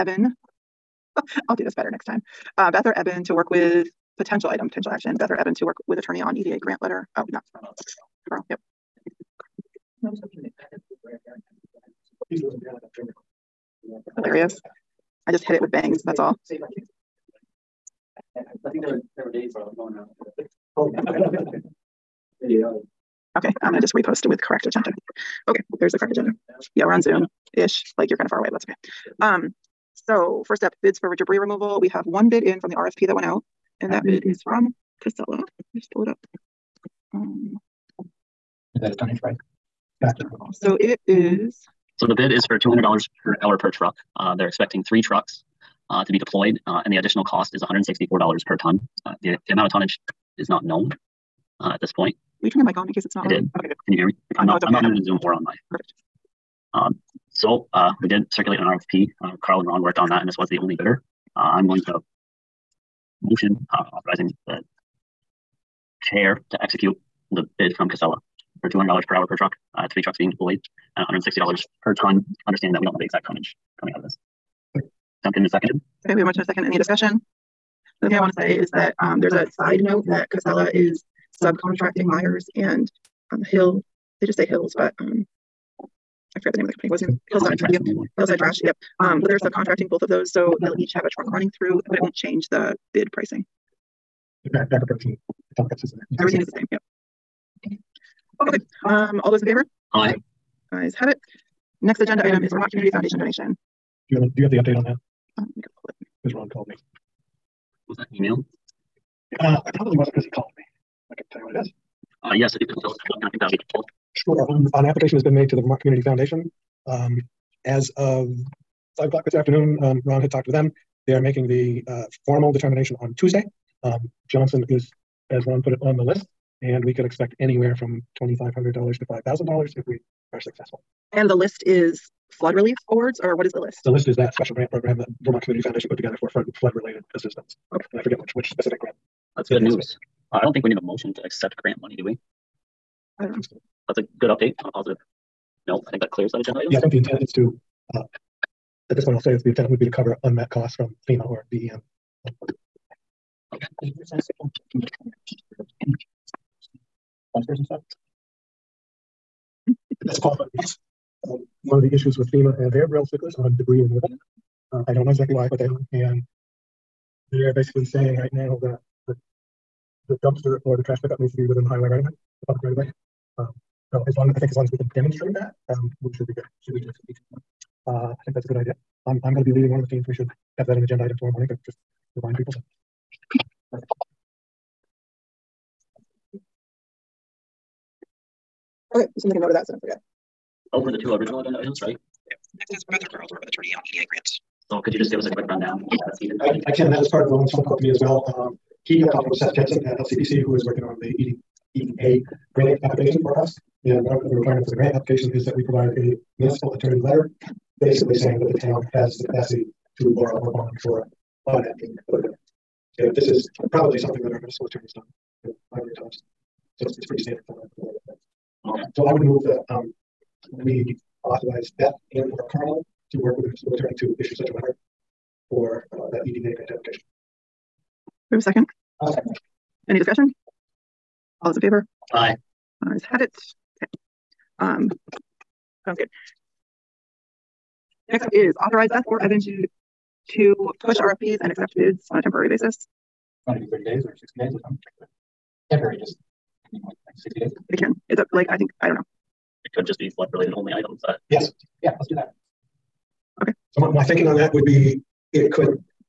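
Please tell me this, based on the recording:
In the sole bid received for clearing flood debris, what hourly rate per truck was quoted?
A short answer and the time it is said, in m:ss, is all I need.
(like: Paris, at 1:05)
$200, at 0:42.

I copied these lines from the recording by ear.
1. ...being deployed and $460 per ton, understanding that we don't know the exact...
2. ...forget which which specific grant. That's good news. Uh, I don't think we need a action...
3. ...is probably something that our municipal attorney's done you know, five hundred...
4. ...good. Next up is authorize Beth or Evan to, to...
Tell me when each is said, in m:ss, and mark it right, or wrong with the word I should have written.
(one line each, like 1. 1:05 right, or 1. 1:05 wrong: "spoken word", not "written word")
1. 1:10 wrong: "160", not "460"
2. 2:18 wrong: "motion", not "action"
3. 3:33 right
4. 3:55 right.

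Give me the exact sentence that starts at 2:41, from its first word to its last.
Um, one of the issues with FEMA and uh, they're real sticklers on debris removal.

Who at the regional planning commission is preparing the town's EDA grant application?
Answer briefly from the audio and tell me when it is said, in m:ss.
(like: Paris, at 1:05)
Seth Jensen, at 3:19.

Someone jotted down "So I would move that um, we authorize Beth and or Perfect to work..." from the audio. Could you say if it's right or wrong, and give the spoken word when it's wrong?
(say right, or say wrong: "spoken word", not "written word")
wrong: "Carl", not "Perfect".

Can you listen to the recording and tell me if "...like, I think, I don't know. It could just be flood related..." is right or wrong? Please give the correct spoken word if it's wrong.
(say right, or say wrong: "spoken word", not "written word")
right.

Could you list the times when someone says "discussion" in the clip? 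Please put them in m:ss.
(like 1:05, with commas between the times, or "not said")
1:16, 3:49.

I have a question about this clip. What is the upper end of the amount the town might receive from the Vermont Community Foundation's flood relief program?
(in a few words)
$5,000.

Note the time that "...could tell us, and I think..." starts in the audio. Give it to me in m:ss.
1:52.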